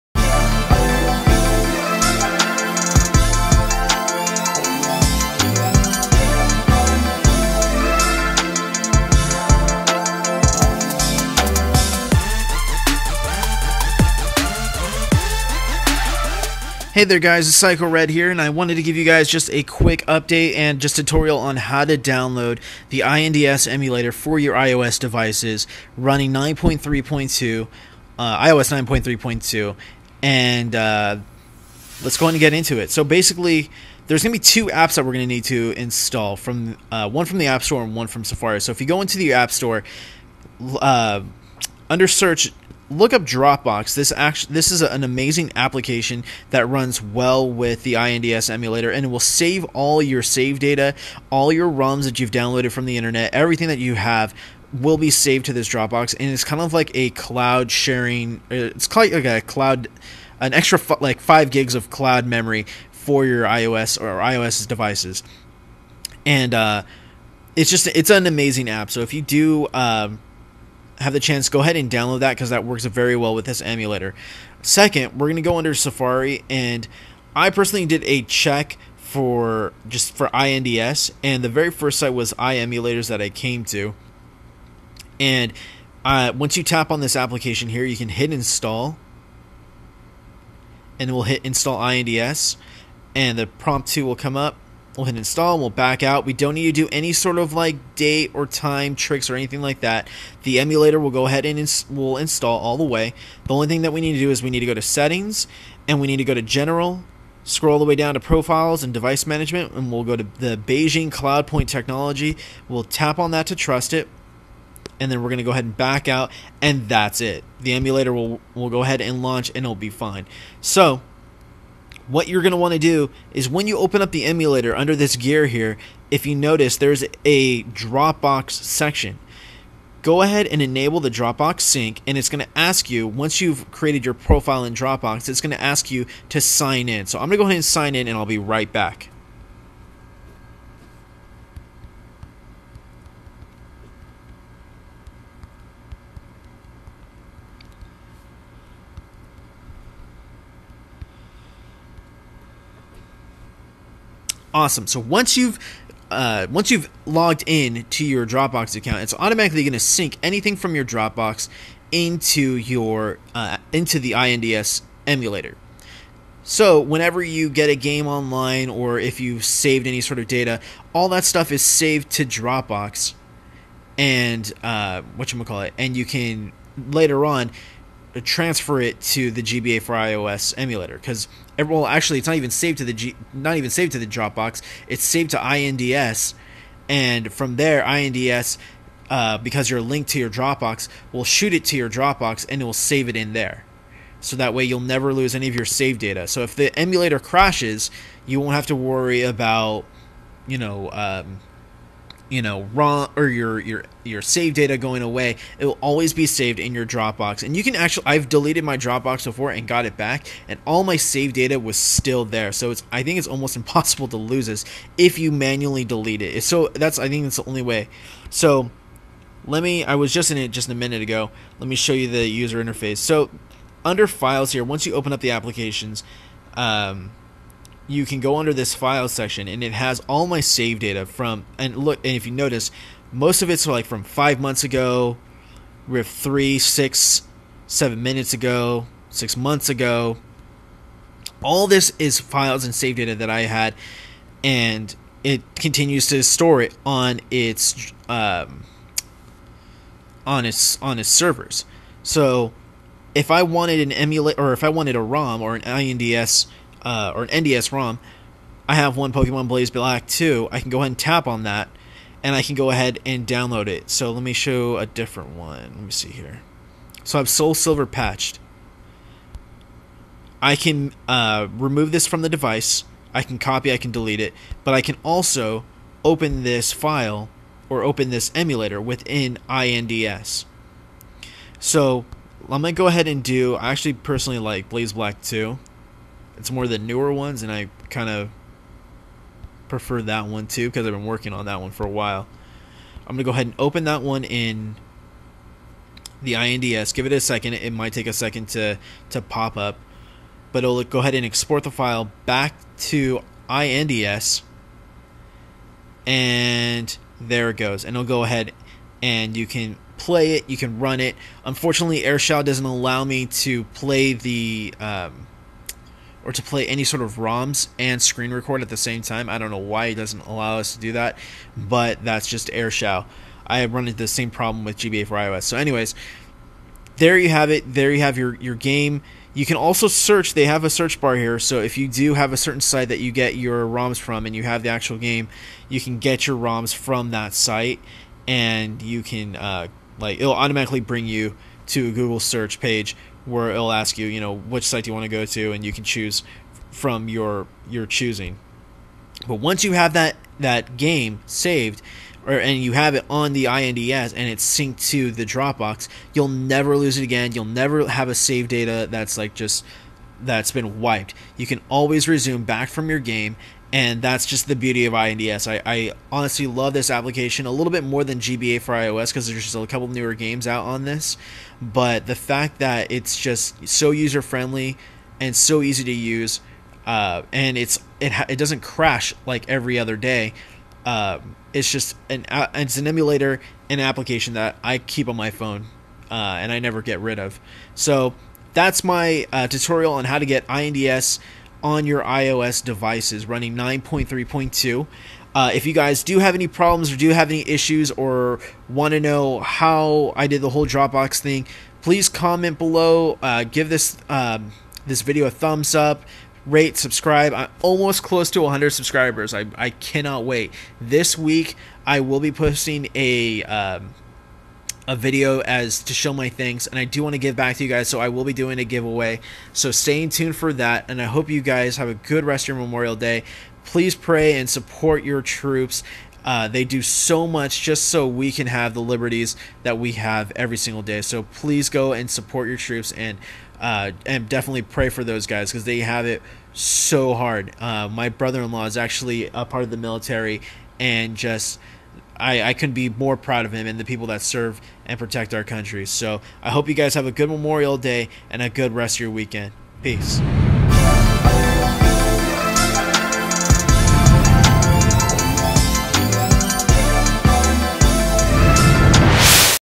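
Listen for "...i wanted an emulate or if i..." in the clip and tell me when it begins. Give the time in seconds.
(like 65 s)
253 s.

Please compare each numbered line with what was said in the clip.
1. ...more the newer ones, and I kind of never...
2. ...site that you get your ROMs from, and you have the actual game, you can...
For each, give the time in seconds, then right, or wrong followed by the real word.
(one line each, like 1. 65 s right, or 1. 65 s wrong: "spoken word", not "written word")
1. 286 s wrong: "prefer", not "never"
2. 332 s right.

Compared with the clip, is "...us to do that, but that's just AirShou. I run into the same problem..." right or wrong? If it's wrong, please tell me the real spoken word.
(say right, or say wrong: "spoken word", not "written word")
right.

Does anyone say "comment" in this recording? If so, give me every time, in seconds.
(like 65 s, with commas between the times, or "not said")
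402 s.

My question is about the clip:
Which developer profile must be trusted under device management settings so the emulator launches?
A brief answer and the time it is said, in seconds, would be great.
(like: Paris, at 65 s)
Beijing CloudPoint technology, at 110 s.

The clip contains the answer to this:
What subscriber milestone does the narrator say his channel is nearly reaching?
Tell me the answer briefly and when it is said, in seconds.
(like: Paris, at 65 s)
100 subscribers, at 408 s.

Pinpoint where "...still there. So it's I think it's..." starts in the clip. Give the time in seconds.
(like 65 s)
211 s.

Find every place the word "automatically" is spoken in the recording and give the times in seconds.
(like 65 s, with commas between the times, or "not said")
159 s, 340 s.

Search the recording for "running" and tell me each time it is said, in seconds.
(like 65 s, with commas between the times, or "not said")
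25 s, 393 s.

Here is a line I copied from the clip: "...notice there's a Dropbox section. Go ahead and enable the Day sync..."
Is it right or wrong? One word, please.
wrong.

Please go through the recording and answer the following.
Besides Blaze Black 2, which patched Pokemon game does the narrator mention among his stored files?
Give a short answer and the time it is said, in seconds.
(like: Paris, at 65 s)
Soul Silver, at 267 s.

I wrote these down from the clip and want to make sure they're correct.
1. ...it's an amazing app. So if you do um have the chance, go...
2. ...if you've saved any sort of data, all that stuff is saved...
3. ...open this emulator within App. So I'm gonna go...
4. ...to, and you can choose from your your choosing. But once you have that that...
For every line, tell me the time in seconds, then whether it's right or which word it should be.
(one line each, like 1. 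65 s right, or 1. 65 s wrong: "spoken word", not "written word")
1. 67 s right
2. 168 s right
3. 277 s wrong: "INDS", not "App"
4. 345 s right.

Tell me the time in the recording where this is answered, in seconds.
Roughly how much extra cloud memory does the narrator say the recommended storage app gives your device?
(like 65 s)
61 s.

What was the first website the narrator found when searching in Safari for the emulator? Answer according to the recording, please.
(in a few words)
iEmulators.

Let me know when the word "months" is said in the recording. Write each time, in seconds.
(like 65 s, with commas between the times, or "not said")
234 s, 239 s.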